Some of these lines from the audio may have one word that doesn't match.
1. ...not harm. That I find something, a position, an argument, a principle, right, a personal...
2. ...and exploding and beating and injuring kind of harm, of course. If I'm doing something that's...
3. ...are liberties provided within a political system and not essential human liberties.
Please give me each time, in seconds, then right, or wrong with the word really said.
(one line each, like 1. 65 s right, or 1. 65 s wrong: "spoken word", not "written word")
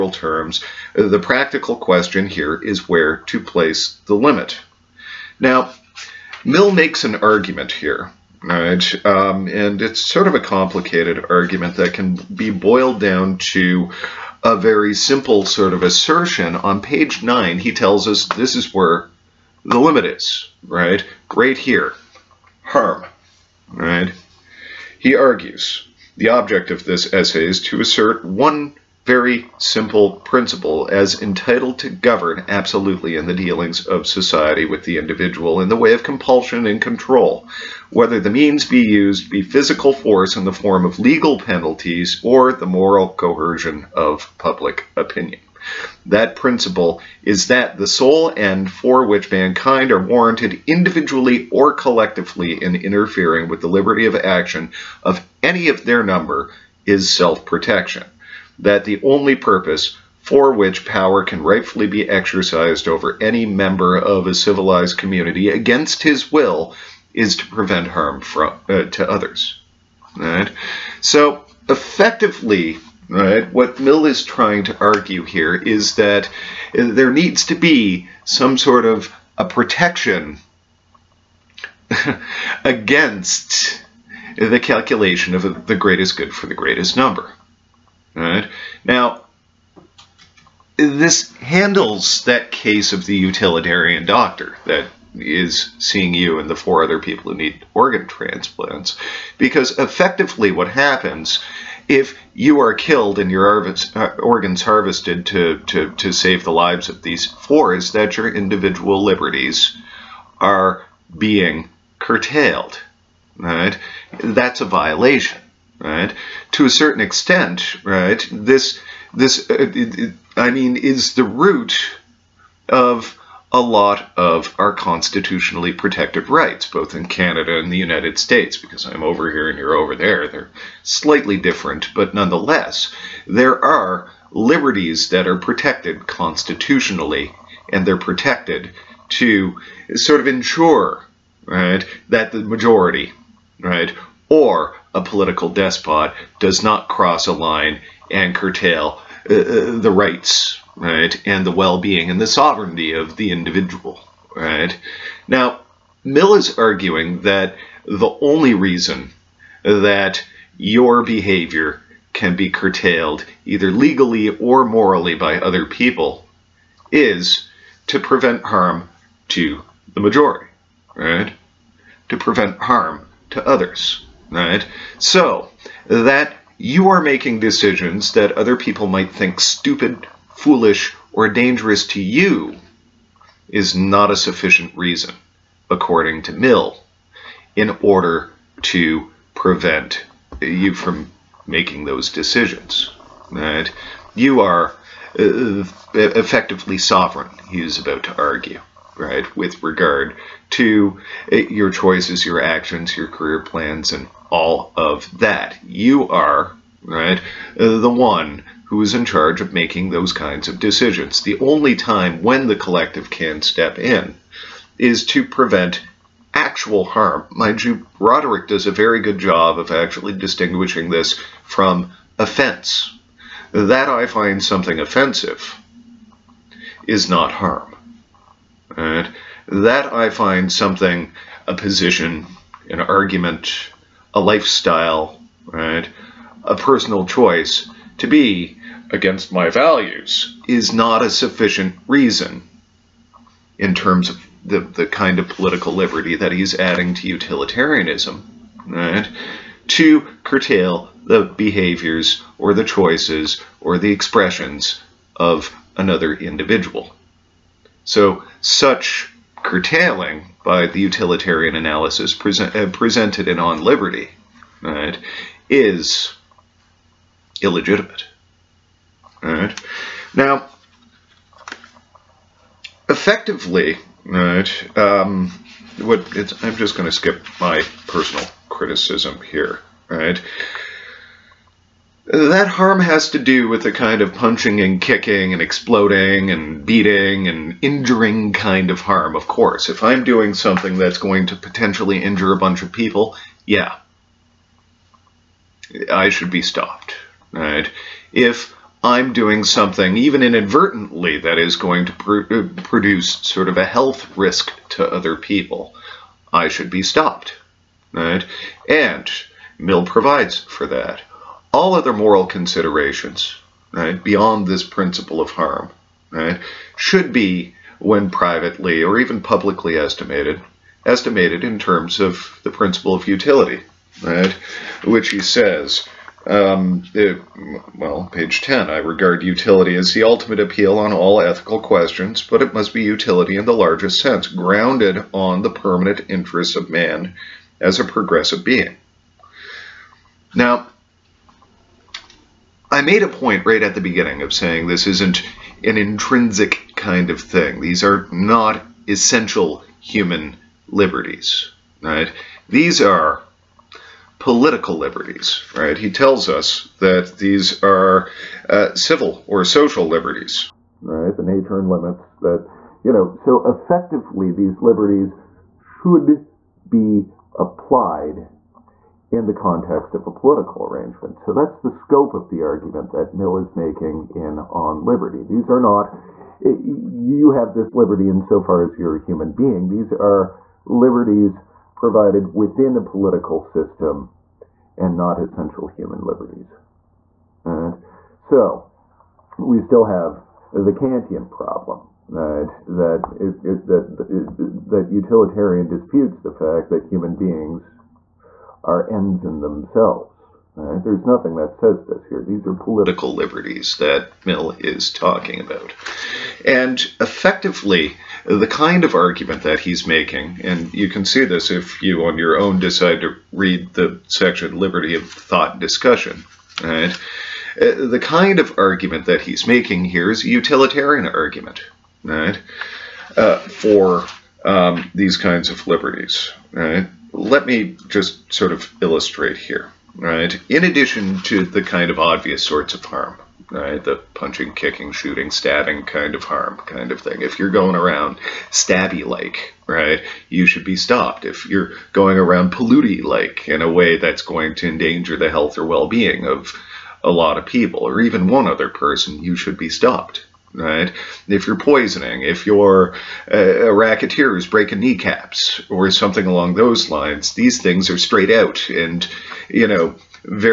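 1. 227 s wrong: "lifestyle", not "principle"
2. 285 s right
3. 379 s right.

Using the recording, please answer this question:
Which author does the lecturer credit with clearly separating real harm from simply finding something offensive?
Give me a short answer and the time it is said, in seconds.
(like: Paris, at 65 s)
Roderick, at 217 s.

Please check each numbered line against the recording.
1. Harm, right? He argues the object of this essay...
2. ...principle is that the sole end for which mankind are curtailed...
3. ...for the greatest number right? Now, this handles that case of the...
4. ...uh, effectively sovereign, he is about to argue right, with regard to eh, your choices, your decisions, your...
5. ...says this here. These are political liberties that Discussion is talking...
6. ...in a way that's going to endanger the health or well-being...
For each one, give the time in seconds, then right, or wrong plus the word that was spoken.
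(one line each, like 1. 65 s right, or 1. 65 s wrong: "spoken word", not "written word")
1. 22 s right
2. 46 s wrong: "warranted", not "curtailed"
3. 86 s right
4. 195 s wrong: "actions", not "decisions"
5. 401 s wrong: "Mill", not "Discussion"
6. 443 s right.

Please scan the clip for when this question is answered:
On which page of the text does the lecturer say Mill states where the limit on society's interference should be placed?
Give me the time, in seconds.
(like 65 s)
16 s.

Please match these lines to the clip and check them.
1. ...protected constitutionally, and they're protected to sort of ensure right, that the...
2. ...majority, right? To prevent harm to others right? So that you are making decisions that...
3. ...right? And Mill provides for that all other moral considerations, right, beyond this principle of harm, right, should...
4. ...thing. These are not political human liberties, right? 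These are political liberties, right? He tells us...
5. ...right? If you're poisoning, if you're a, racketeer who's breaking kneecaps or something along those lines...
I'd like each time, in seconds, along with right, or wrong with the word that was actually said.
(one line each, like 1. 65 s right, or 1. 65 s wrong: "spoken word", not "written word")
1. 135 s right
2. 169 s right
3. 307 s right
4. 347 s wrong: "essential", not "political"
5. 450 s right.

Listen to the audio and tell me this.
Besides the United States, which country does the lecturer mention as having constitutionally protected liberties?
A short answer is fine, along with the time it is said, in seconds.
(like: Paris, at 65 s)
Canada, at 127 s.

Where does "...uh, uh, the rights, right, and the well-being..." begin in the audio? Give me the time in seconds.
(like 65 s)
149 s.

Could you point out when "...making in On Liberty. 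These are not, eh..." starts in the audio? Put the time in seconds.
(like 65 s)
373 s.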